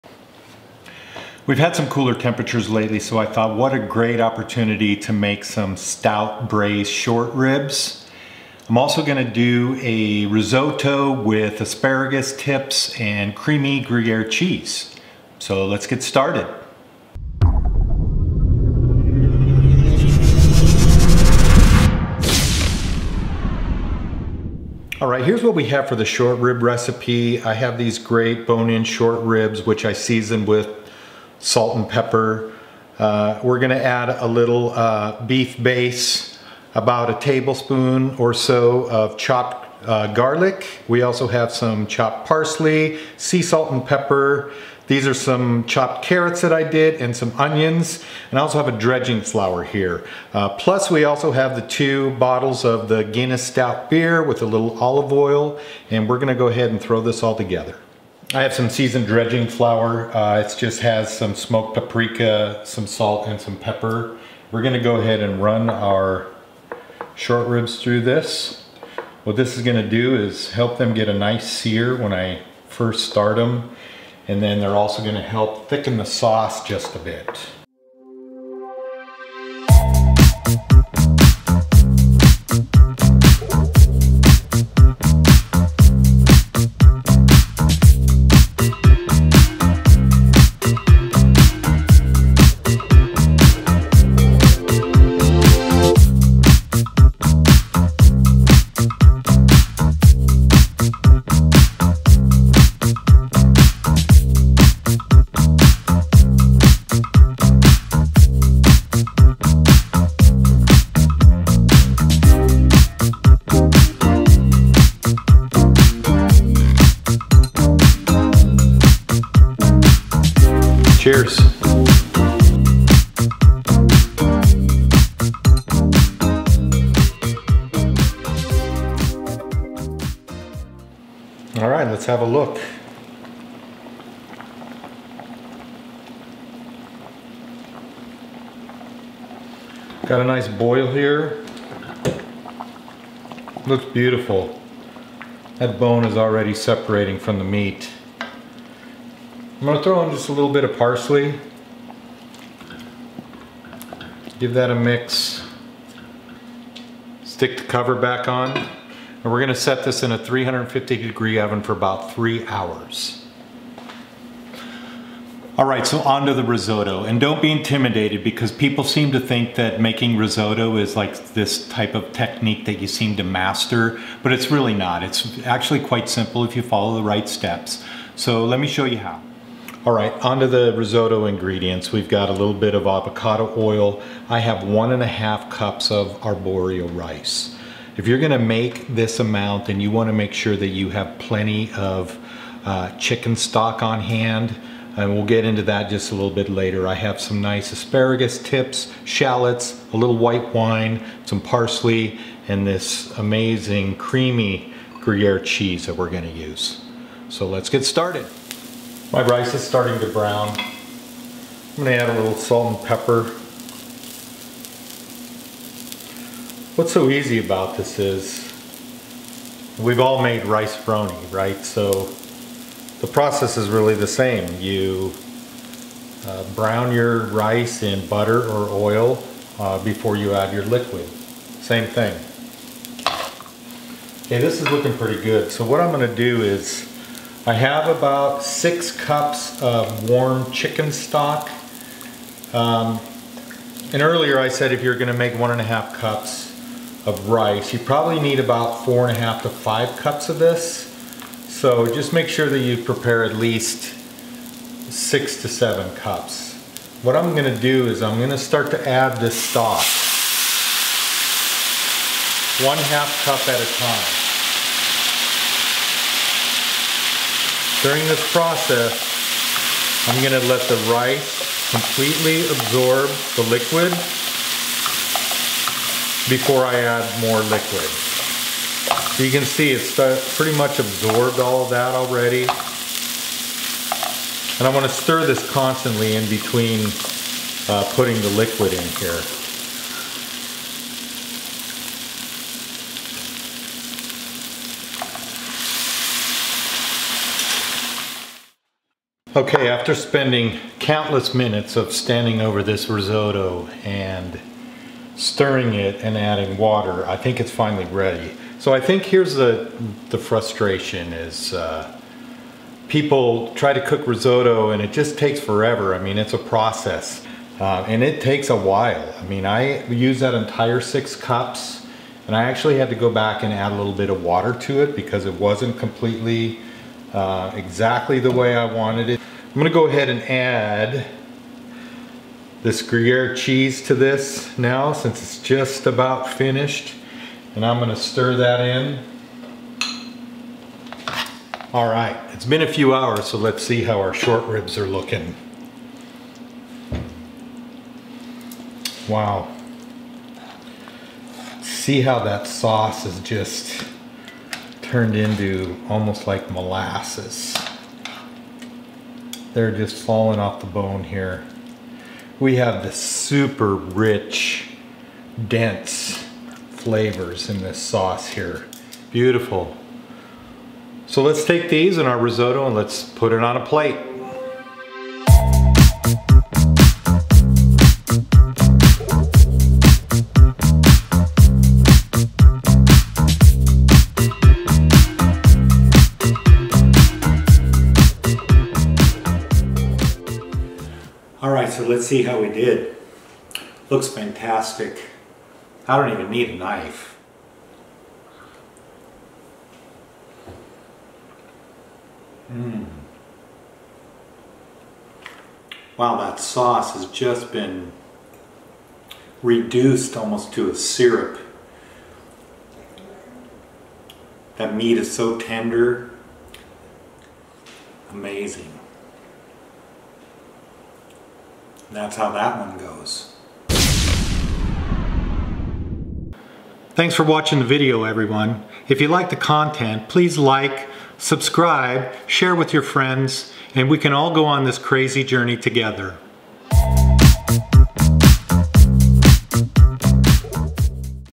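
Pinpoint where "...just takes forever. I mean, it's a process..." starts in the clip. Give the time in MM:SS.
05:14.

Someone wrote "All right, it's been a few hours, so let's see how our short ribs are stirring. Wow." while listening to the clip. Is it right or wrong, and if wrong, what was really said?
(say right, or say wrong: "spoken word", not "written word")
wrong: "looking", not "stirring".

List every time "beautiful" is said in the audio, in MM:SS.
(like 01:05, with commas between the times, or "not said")
02:23, 06:09.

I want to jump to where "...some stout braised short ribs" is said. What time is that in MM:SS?
00:05.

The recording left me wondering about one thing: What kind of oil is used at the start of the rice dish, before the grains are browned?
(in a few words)
Avocado oil.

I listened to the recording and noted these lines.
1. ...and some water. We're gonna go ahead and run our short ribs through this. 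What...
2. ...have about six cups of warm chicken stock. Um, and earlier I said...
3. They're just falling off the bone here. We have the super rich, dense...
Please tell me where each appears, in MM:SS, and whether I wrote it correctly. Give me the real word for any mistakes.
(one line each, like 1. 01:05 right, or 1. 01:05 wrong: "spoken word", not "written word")
1. 01:03 wrong: "pepper", not "water"
2. 03:57 right
3. 05:59 right.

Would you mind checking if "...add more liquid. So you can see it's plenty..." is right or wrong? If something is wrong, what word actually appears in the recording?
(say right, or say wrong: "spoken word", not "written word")
wrong: "pretty", not "plenty".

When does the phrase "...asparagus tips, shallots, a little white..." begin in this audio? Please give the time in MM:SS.
03:17.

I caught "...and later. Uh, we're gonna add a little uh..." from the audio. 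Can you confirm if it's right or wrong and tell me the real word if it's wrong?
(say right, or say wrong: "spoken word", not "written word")
wrong: "pepper", not "later".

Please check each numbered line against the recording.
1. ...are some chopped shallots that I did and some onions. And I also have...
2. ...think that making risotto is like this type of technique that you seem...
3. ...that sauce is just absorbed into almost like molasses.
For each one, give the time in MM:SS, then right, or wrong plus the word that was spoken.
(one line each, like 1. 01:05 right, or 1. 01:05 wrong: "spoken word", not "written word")
1. 00:45 wrong: "carrots", not "shallots"
2. 02:49 right
3. 05:52 wrong: "turned", not "absorbed".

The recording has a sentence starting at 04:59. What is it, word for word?
Okay, after spending countless minutes of standing over this risotto and stirring it and adding water, I think it's finally ready.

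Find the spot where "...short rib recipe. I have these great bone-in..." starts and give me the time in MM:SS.
00:26.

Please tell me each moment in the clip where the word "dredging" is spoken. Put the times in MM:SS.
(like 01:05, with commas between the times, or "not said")
00:48, 00:59.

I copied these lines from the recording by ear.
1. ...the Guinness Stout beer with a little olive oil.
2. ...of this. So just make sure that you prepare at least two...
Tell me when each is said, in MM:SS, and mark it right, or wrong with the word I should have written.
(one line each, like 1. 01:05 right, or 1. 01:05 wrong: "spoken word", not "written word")
1. 00:52 right
2. 04:10 wrong: "six", not "two".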